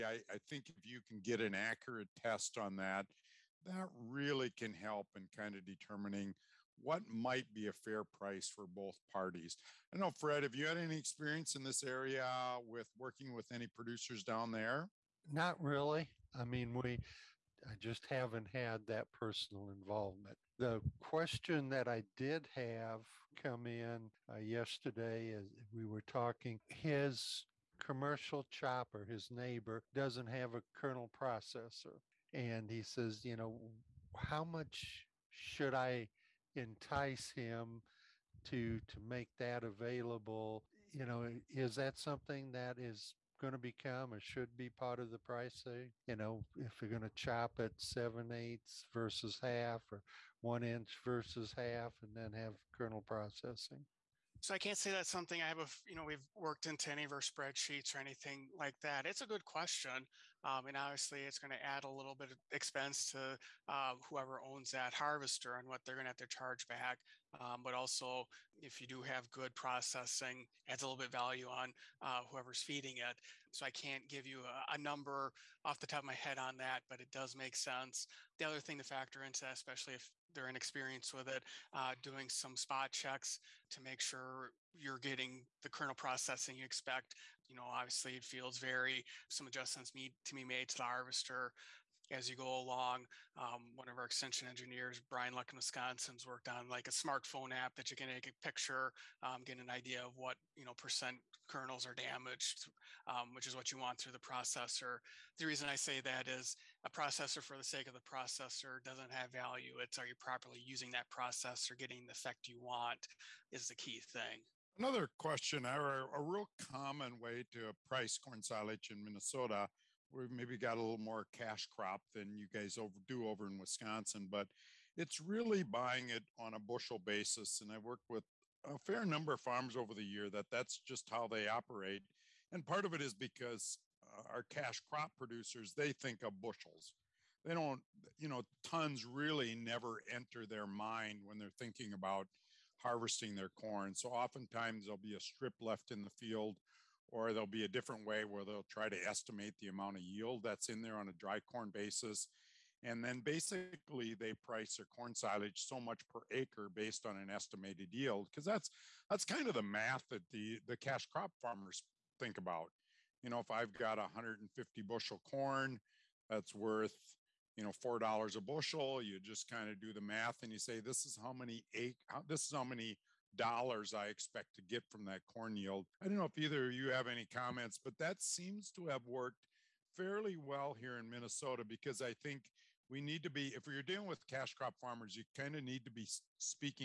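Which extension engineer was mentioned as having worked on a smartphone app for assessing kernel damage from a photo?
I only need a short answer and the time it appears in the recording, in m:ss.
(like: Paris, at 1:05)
Brian Luck, at 1:35.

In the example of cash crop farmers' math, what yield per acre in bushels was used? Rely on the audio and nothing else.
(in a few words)
150.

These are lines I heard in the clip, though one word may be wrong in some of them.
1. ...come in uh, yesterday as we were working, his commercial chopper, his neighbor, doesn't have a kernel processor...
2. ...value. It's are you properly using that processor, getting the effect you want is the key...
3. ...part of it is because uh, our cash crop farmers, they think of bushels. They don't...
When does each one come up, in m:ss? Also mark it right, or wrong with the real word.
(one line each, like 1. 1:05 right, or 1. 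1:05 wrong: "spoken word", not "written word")
1. 0:23 wrong: "talking", not "working"
2. 1:49 right
3. 2:12 wrong: "producers", not "farmers".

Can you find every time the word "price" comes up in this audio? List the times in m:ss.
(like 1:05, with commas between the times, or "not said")
0:08, 0:45, 1:57, 2:34.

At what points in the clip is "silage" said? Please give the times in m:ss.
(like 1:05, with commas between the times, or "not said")
1:58, 2:35.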